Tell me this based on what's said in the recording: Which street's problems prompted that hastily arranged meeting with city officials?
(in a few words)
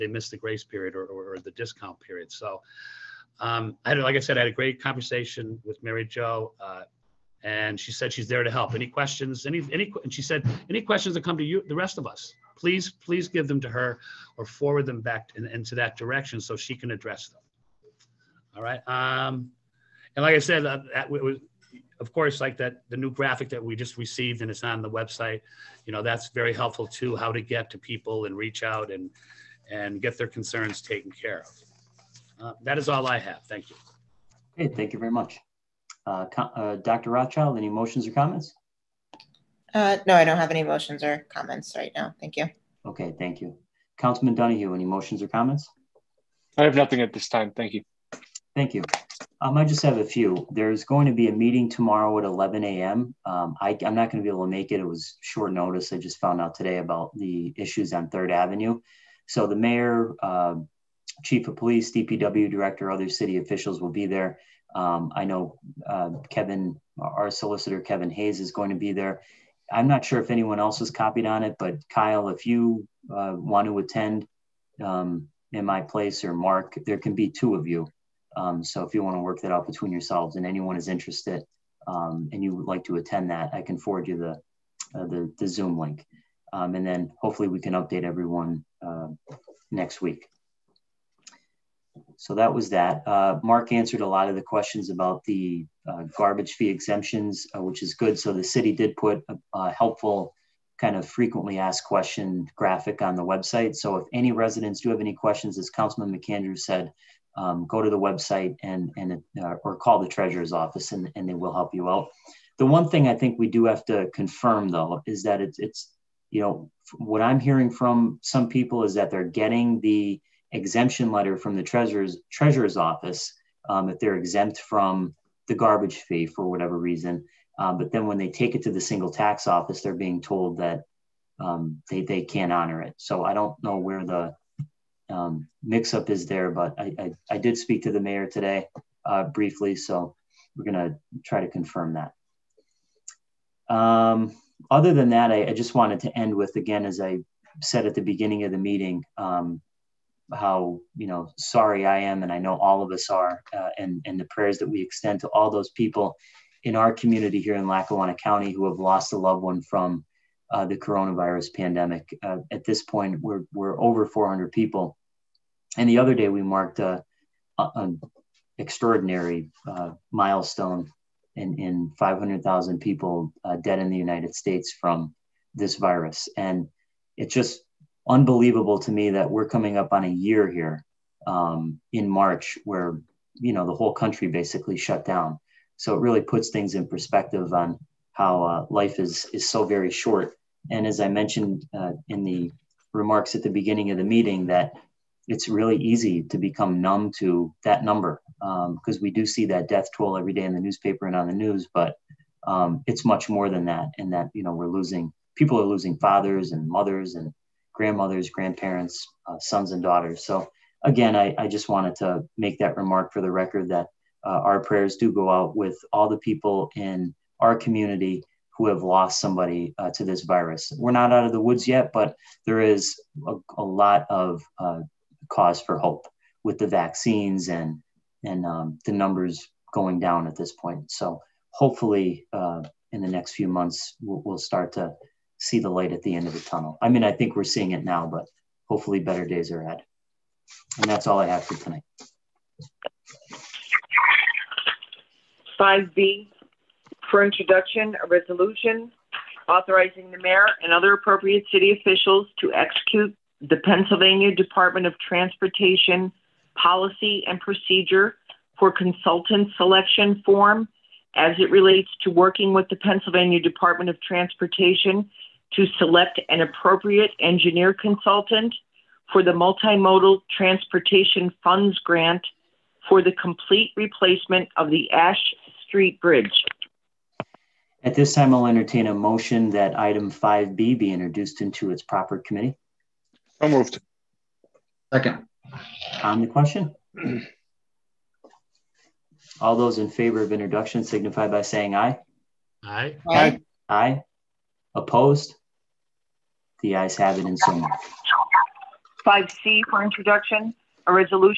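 Third Avenue.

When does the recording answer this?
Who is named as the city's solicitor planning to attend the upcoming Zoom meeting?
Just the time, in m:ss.
1:07.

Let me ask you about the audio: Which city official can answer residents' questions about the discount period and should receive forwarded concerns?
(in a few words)
Mary Jo.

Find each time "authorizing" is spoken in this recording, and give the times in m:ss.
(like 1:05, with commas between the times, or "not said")
4:09.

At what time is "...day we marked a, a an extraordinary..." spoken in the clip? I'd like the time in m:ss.
2:46.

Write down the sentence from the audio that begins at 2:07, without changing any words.
Uh, but then when they take it to the single tax office, they're being told that um, they, they can't honor it.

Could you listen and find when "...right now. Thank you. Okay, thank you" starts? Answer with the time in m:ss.
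0:41.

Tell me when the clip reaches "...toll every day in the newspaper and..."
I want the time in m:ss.
3:19.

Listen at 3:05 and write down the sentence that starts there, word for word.
So it really puts things in perspective on how uh, life is is so very short.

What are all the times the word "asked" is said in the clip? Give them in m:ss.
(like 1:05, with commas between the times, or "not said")
1:41.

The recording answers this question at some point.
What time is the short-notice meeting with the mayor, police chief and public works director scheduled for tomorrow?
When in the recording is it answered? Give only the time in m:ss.
0:52.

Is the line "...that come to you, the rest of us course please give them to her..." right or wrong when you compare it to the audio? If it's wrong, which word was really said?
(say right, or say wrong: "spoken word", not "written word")
wrong: "please", not "course".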